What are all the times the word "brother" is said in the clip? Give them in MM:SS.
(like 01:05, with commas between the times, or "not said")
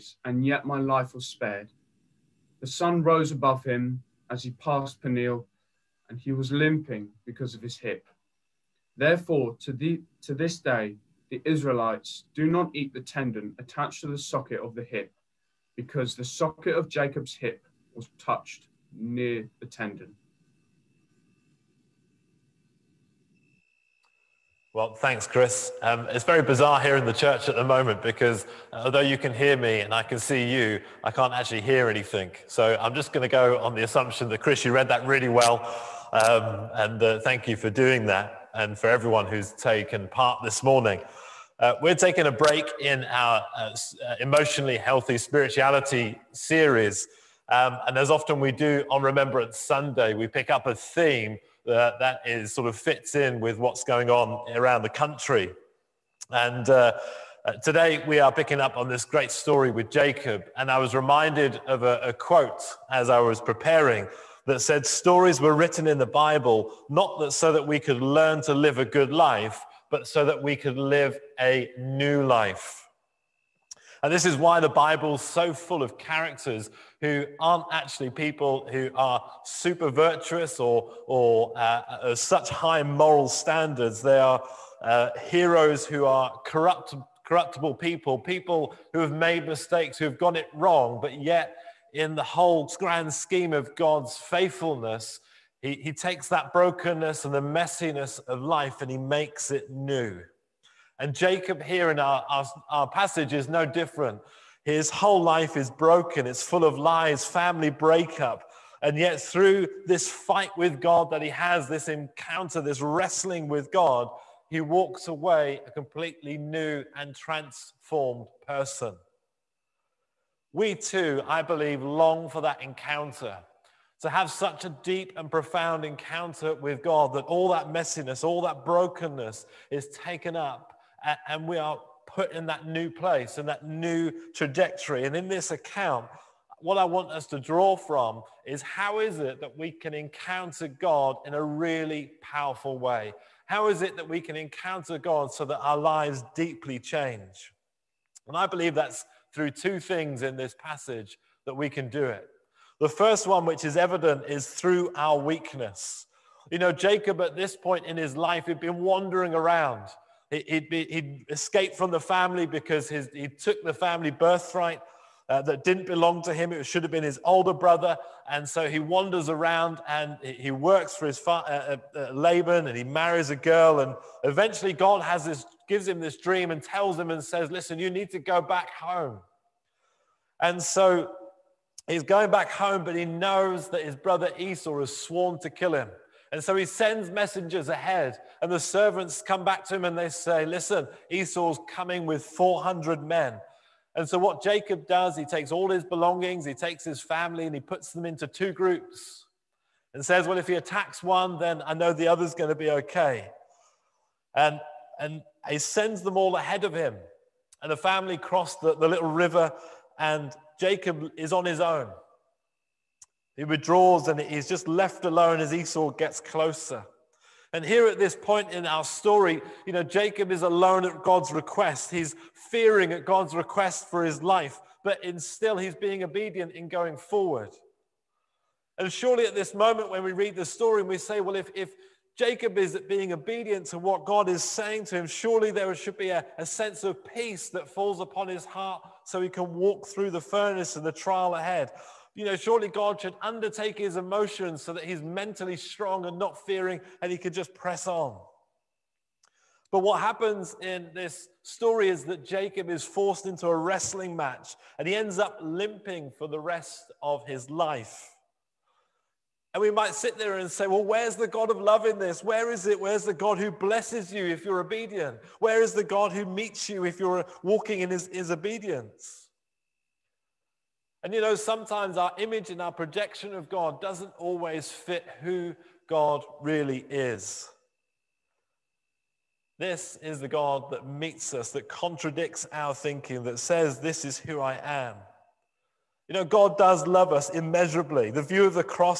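02:47, 03:03.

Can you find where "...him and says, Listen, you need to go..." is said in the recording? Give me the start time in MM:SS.
02:56.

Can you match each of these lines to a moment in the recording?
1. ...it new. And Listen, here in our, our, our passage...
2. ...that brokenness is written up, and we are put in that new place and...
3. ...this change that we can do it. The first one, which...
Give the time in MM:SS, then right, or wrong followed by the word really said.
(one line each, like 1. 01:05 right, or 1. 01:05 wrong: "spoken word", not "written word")
1. 01:39 wrong: "Jacob", not "Listen"
2. 02:08 wrong: "taken", not "written"
3. 02:30 wrong: "passage", not "change".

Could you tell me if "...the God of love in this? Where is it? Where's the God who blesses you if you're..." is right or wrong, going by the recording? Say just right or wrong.
right.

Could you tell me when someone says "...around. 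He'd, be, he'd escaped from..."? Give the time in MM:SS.
02:39.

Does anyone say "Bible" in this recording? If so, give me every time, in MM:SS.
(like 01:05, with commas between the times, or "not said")
01:06, 01:14.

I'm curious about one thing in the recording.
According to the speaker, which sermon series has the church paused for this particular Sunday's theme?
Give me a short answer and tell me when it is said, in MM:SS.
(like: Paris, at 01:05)
Emotionally healthy spirituality, at 00:44.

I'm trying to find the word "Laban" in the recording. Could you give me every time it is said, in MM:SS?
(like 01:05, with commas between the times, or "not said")
02:52.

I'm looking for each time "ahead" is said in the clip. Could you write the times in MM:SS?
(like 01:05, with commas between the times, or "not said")
03:07, 03:26, 04:01.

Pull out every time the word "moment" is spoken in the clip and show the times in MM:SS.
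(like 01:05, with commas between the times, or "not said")
00:27, 03:49.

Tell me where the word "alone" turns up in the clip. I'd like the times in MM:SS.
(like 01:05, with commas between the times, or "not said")
03:35, 03:40.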